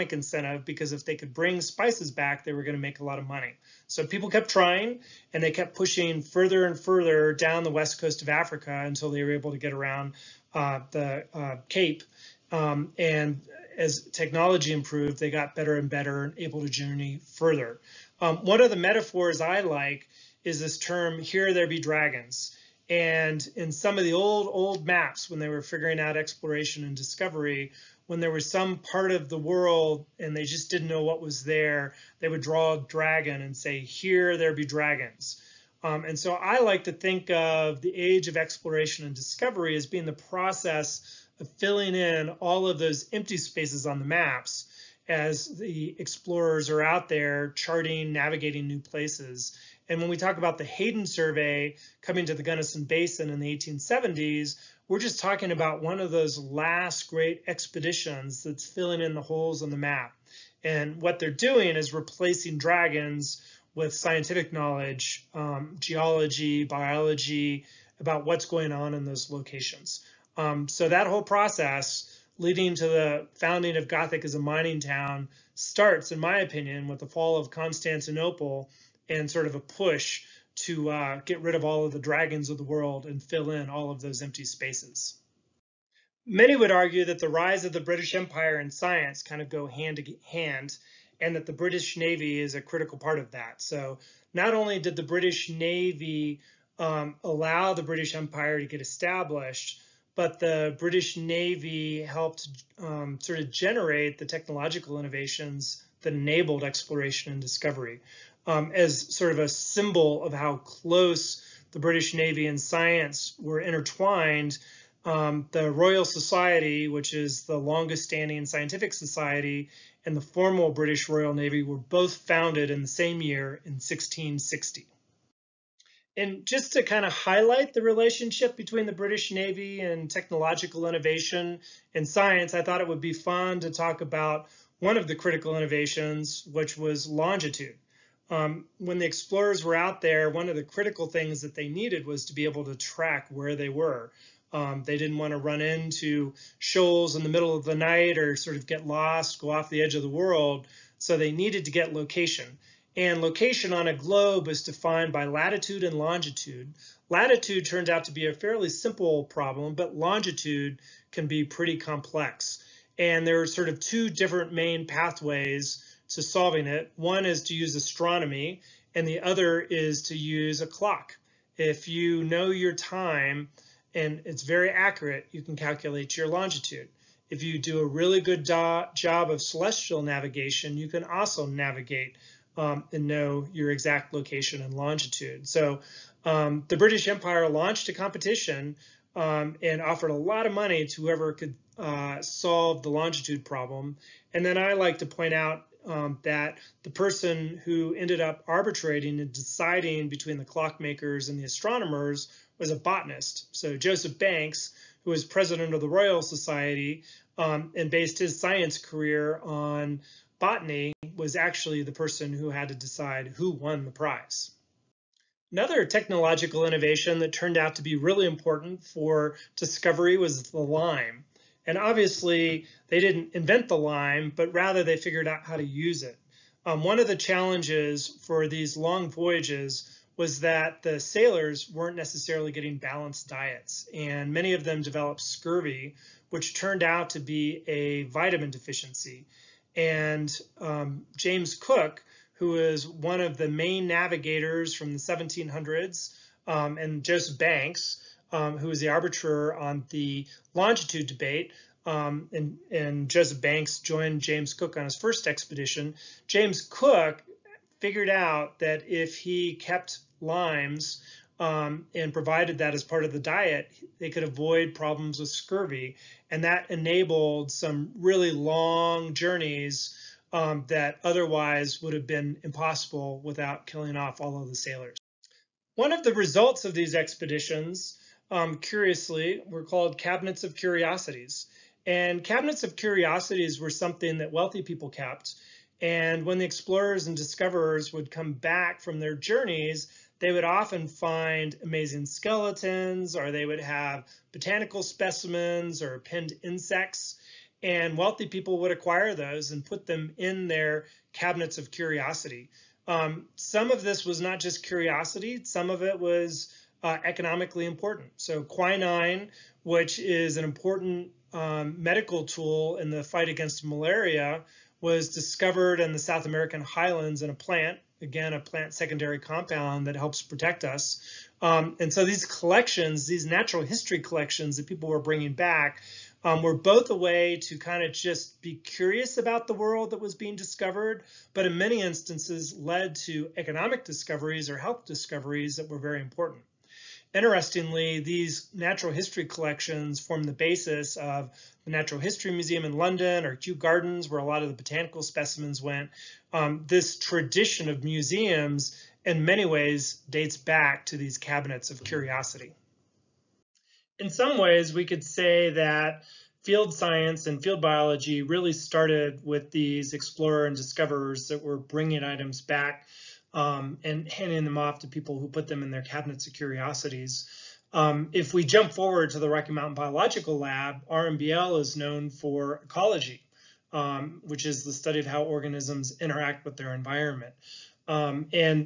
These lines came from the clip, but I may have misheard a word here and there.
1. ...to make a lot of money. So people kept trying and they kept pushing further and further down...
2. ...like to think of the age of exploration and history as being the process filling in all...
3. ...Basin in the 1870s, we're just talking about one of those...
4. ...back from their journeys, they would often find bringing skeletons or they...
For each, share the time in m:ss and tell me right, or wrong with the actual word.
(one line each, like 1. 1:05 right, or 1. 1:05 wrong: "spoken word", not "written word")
1. 0:02 right
2. 0:36 wrong: "discovery", not "history"
3. 0:52 right
4. 4:48 wrong: "amazing", not "bringing".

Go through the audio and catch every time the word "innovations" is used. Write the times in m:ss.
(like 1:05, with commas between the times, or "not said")
1:44, 2:10, 2:15, 3:36.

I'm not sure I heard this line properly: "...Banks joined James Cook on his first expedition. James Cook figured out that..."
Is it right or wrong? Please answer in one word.
right.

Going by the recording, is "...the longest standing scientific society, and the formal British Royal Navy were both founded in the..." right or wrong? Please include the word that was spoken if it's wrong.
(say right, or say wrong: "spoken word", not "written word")
right.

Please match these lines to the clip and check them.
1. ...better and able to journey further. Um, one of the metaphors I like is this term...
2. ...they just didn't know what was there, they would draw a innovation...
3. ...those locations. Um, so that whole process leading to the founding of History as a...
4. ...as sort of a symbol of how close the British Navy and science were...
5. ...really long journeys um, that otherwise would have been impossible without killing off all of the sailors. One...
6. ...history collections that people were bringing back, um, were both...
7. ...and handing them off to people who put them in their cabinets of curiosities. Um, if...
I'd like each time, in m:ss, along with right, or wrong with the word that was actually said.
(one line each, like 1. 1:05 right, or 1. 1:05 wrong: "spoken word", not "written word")
1. 0:15 right
2. 0:30 wrong: "dragon", not "innovation"
3. 1:09 wrong: "Gothic", not "History"
4. 1:48 right
5. 4:27 right
6. 5:23 right
7. 6:03 right.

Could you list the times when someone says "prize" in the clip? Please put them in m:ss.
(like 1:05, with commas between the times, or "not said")
3:33.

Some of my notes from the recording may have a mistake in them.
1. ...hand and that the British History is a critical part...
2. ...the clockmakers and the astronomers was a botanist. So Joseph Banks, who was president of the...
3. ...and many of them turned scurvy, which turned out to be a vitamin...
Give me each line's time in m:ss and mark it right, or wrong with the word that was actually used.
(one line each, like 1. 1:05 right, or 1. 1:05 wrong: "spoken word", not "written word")
1. 1:30 wrong: "Navy", not "History"
2. 3:20 right
3. 3:53 wrong: "developed", not "turned".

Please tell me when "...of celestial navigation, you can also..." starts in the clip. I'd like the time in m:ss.
2:59.